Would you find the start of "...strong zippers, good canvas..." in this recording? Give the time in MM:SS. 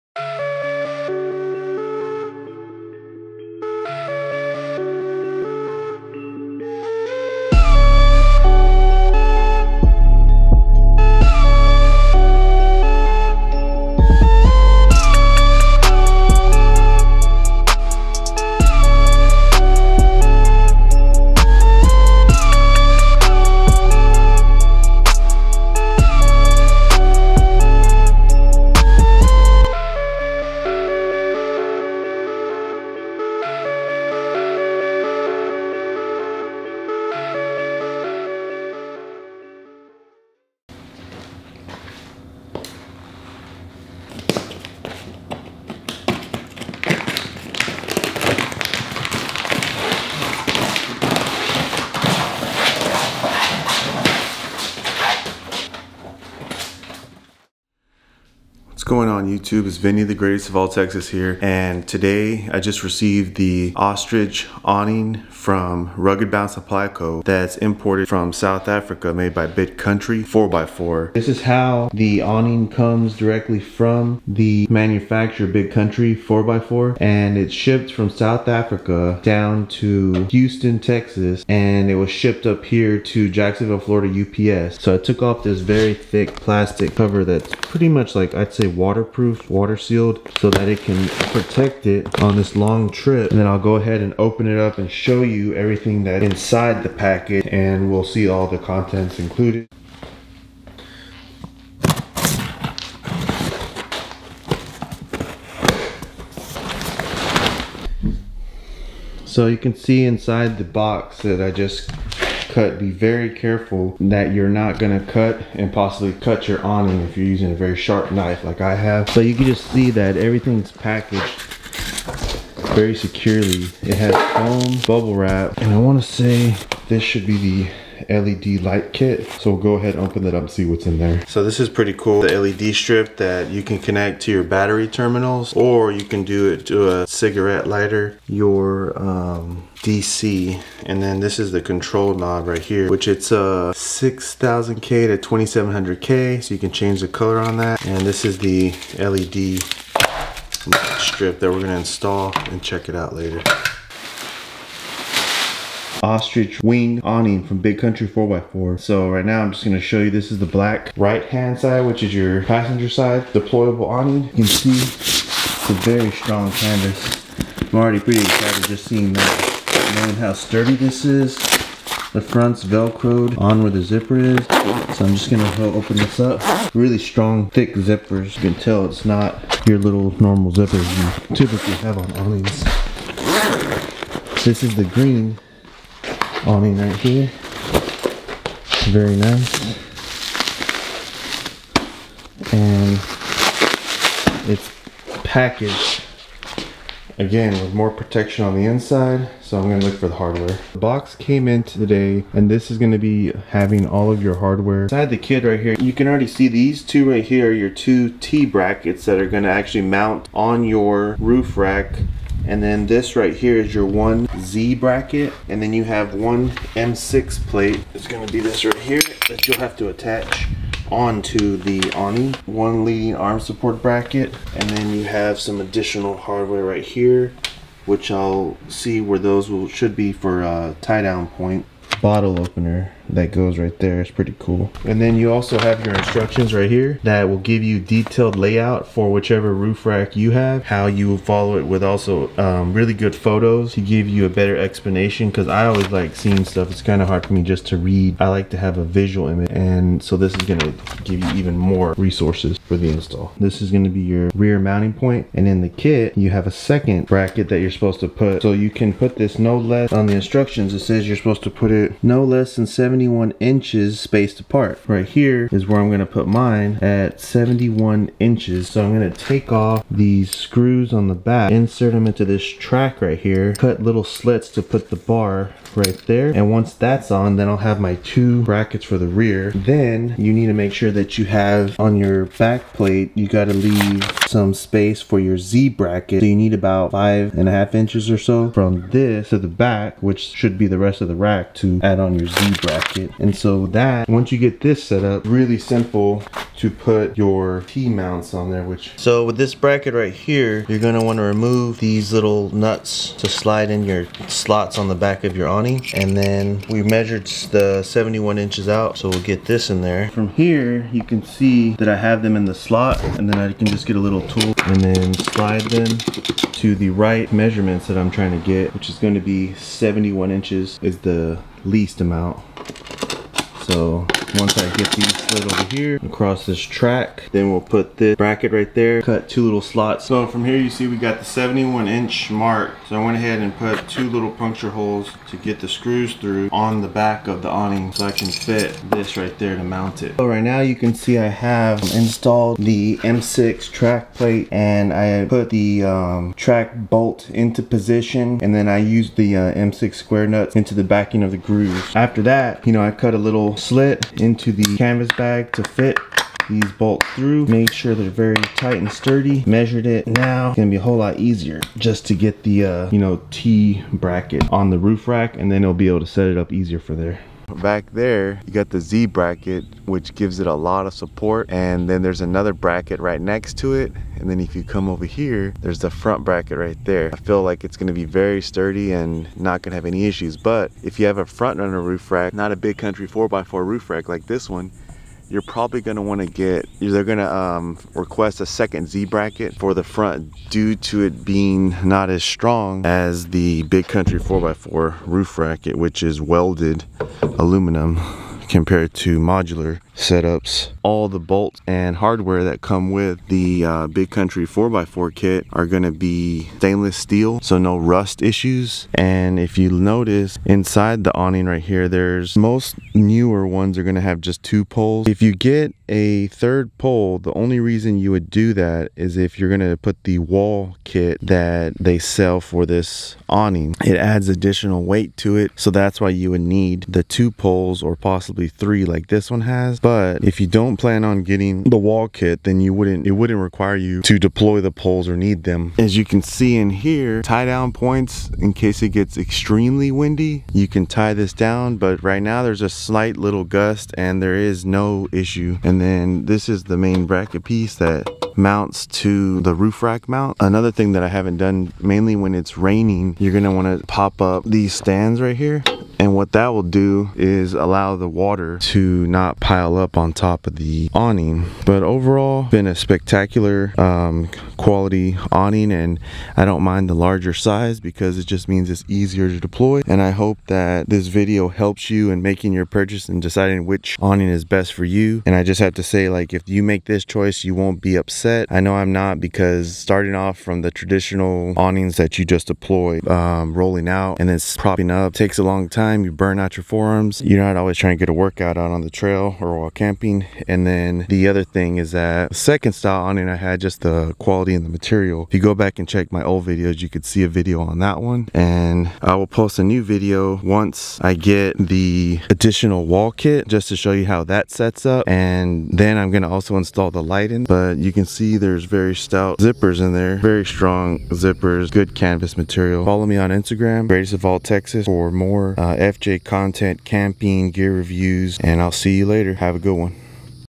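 08:30.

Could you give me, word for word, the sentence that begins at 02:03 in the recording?
It has foam bubble wrap and I wanna say this should be the LED light kit.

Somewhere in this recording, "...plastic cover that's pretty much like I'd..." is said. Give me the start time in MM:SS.
01:26.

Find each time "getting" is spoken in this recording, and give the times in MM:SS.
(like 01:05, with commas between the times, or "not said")
07:11.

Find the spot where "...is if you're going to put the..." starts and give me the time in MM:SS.
06:58.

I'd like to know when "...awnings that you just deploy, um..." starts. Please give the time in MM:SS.
08:01.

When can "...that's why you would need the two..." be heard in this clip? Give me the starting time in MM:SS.
07:05.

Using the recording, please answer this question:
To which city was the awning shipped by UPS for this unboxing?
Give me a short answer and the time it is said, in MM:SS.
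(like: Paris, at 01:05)
Jacksonville, Florida, at 01:23.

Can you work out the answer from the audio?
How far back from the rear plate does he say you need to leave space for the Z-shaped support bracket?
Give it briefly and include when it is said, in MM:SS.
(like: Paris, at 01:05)
5.5 inches, at 04:46.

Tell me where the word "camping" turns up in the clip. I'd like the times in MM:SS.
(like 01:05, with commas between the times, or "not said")
08:09, 08:36.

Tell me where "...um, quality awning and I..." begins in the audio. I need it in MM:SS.
07:43.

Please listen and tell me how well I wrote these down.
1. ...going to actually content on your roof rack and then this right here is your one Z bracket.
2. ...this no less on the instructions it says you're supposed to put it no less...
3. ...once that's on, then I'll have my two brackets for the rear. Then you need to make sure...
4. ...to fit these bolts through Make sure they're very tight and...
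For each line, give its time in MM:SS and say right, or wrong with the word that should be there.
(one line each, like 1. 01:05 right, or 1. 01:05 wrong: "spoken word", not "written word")
1. 03:29 wrong: "mount", not "content"
2. 04:19 right
3. 04:36 right
4. 05:55 right.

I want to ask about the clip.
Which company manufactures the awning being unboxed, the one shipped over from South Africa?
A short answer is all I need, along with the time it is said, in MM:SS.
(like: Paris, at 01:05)
Big Country 4x4, at 01:09.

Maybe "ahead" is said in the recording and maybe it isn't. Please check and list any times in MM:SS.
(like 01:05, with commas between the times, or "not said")
01:33, 02:09, 05:33.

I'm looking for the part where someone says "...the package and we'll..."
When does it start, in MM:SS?
01:36.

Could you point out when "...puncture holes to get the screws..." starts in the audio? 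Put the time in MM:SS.
05:34.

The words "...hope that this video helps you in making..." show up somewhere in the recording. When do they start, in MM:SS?
07:50.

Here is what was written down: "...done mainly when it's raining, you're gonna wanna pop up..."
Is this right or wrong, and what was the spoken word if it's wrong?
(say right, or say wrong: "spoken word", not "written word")
right.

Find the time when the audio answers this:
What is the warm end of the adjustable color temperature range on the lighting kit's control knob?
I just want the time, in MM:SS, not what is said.
02:25.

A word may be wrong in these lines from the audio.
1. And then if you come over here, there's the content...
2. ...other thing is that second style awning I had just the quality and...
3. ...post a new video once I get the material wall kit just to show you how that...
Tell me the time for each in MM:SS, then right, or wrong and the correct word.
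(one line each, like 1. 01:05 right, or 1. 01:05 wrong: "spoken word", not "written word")
1. 06:14 wrong: "front", not "content"
2. 08:11 right
3. 08:19 wrong: "additional", not "material".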